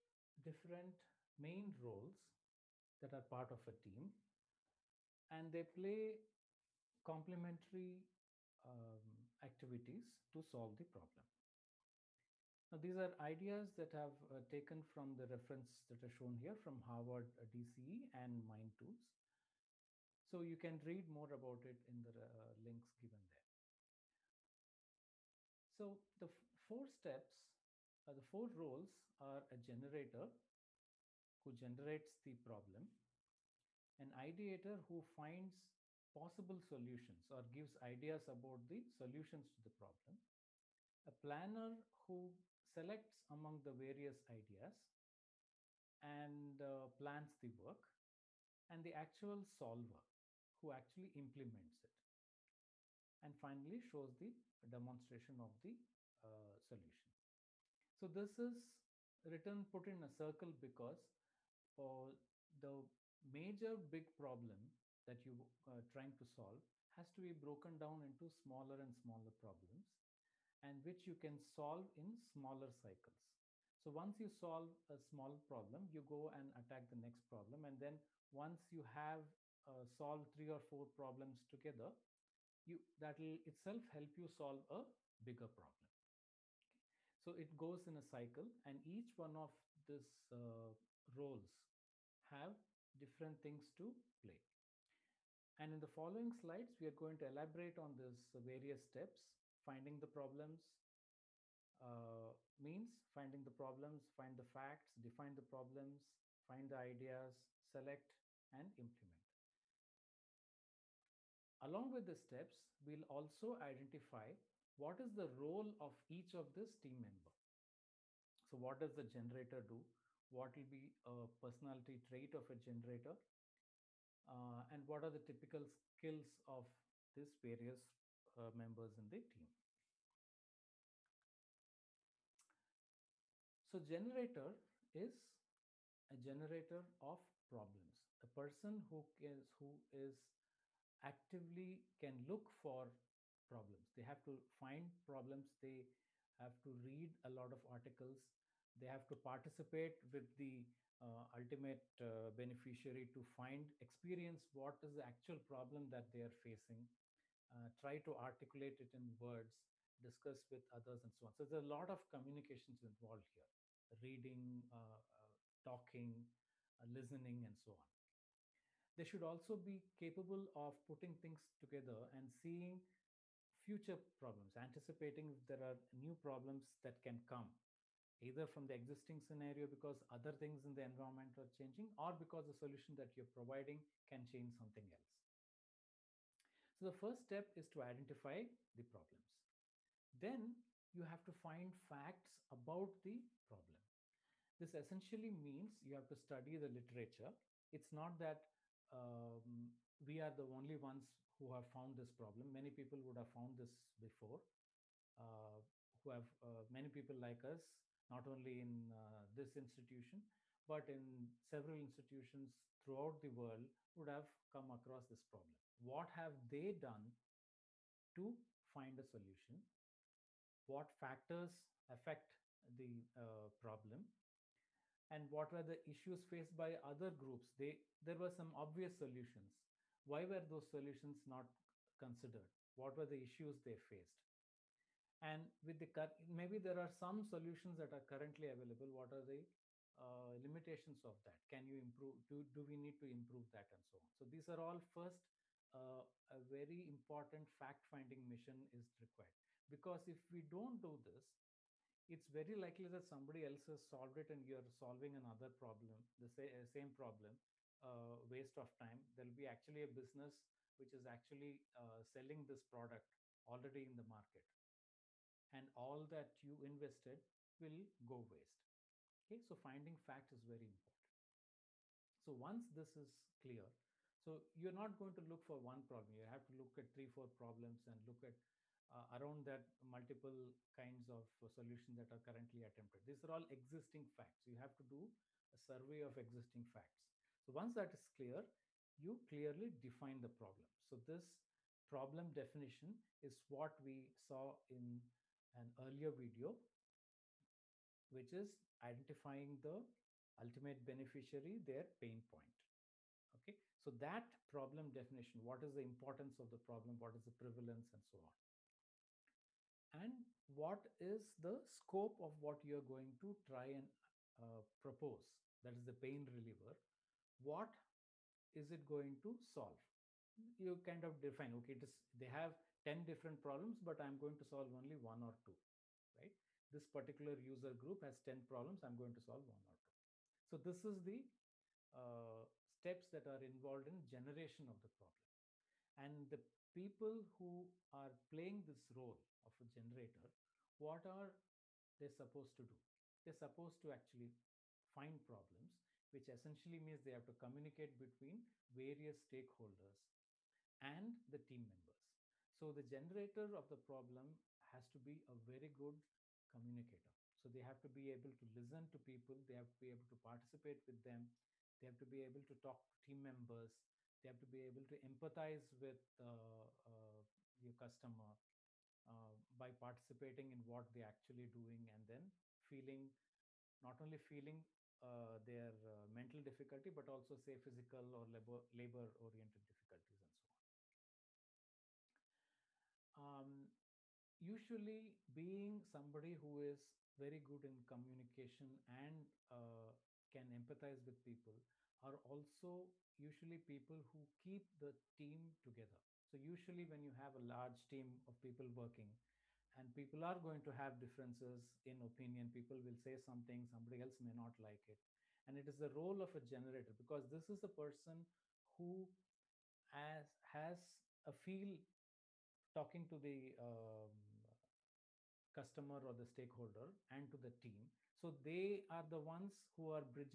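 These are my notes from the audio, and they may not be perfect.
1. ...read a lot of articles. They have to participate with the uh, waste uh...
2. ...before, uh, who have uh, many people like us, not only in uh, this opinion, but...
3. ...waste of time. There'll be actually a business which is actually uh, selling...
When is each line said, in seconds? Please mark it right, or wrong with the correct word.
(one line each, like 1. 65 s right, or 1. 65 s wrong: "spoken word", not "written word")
1. 146 s wrong: "ultimate", not "waste"
2. 203 s wrong: "institution", not "opinion"
3. 258 s right.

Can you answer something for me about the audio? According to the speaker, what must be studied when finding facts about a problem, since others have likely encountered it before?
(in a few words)
the literature.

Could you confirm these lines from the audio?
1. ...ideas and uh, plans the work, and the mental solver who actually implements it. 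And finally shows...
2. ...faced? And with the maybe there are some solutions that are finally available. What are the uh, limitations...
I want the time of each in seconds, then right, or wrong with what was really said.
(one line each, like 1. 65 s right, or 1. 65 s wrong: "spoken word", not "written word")
1. 44 s wrong: "actual", not "mental"
2. 233 s wrong: "currently", not "finally".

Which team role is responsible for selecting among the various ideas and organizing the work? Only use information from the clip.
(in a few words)
planner.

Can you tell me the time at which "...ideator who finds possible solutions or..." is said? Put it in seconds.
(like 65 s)
34 s.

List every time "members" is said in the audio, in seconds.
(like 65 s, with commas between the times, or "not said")
116 s, 128 s, 351 s, 363 s.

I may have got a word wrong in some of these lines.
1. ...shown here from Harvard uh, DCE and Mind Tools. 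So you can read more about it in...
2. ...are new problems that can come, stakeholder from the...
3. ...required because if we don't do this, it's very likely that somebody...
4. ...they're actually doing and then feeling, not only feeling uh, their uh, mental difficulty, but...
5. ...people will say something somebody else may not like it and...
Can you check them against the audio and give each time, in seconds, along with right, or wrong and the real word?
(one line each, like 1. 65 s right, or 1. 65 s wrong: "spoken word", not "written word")
1. 16 s right
2. 175 s wrong: "either", not "stakeholder"
3. 248 s right
4. 370 s right
5. 402 s right.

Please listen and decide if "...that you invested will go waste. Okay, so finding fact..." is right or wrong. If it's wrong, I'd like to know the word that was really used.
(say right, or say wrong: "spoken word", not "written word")
right.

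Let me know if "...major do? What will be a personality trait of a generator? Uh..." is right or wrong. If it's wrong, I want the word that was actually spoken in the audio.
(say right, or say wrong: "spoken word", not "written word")
wrong: "generator", not "major".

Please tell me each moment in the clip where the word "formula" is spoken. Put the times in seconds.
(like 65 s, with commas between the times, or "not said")
not said.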